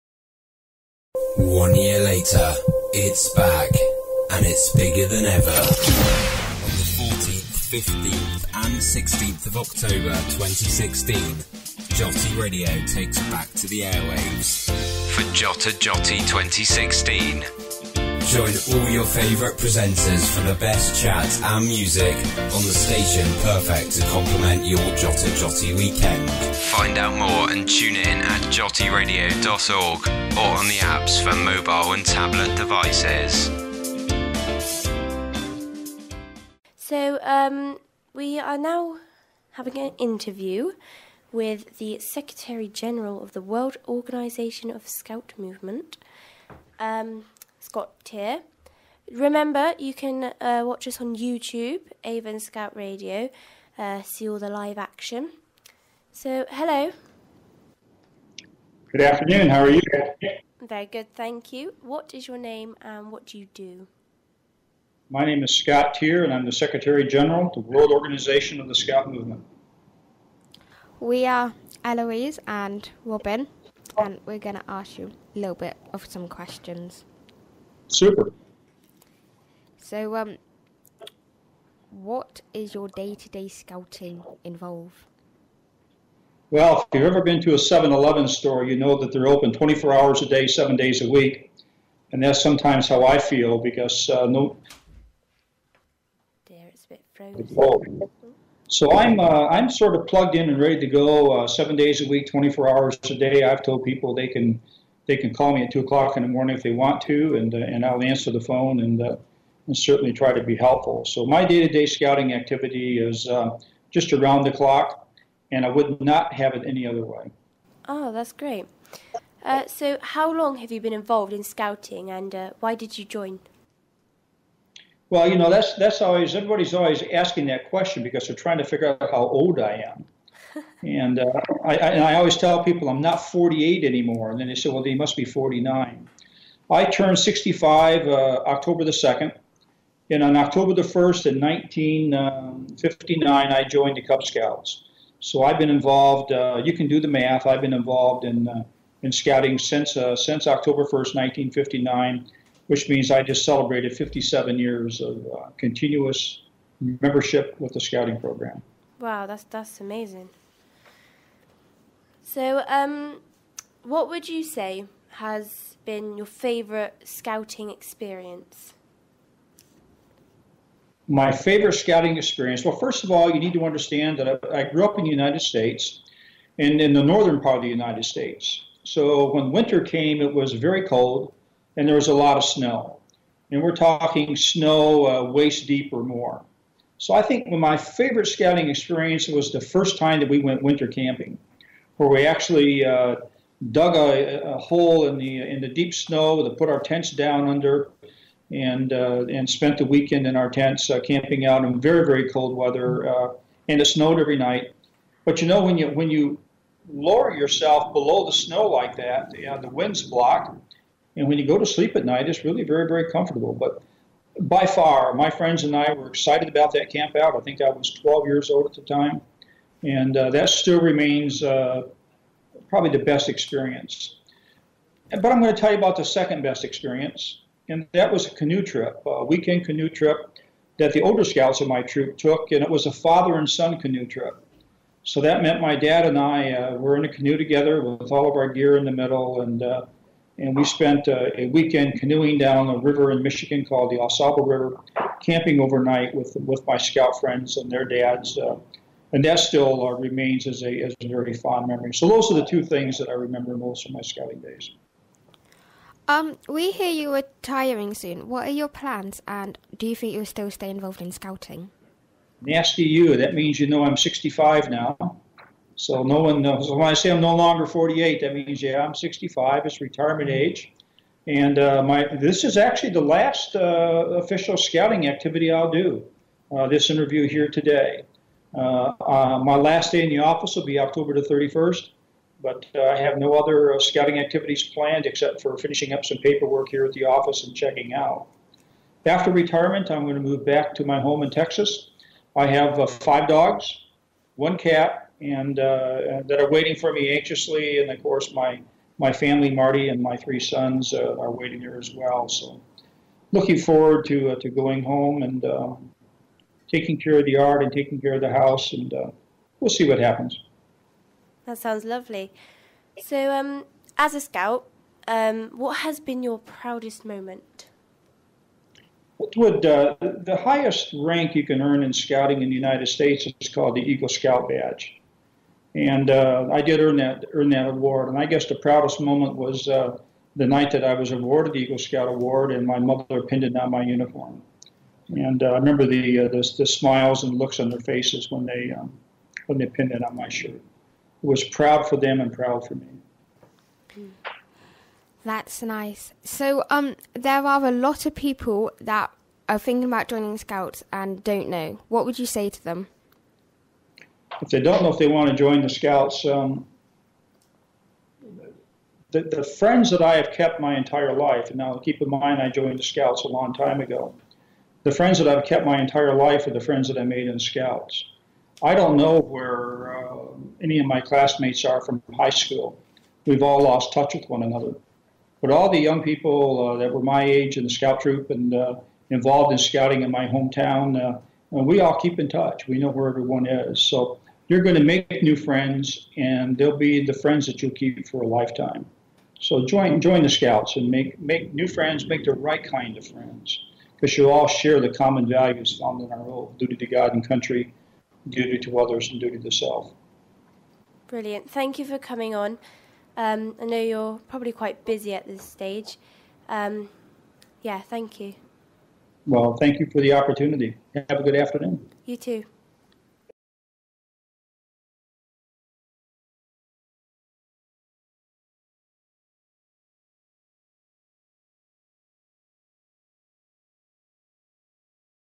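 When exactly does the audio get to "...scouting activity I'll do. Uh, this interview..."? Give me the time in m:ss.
4:34.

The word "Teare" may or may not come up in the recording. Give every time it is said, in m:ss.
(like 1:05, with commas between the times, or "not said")
0:48, 1:05.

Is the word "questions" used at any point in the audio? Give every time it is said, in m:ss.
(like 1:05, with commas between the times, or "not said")
1:16, 2:07.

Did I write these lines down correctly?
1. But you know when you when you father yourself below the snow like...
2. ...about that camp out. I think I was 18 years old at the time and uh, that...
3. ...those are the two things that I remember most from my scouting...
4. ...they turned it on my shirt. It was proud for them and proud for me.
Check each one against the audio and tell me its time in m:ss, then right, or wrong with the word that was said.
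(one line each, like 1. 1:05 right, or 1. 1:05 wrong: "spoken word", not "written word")
1. 3:25 wrong: "lower", not "father"
2. 3:36 wrong: "12", not "18"
3. 4:12 right
4. 5:39 wrong: "pinned", not "turned".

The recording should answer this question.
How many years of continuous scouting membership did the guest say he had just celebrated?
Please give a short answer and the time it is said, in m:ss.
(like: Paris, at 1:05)
57, at 2:33.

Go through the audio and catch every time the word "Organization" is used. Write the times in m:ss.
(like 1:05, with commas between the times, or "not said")
0:43, 1:07.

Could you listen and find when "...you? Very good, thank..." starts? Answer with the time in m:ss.
0:59.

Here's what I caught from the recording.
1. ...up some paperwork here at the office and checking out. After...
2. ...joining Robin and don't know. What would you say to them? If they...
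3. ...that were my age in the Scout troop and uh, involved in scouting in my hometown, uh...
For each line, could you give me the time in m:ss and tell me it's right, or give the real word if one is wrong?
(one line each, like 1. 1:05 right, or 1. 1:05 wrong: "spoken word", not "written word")
1. 4:45 right
2. 5:50 wrong: "Scouts", not "Robin"
3. 6:16 right.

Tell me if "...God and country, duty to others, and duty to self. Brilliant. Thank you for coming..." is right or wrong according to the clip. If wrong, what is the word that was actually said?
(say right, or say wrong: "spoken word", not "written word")
right.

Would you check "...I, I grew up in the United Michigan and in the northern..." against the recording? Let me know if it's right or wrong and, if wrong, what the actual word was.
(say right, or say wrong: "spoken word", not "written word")
wrong: "States", not "Michigan".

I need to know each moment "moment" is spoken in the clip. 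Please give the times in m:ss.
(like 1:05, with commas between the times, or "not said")
5:17, 5:28.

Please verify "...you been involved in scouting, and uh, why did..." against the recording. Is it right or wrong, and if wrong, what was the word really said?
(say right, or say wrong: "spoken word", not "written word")
right.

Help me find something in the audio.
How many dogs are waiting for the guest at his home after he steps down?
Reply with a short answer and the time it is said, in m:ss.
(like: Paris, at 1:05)
5, at 4:53.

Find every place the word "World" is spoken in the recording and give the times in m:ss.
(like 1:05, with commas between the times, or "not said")
0:43, 1:07.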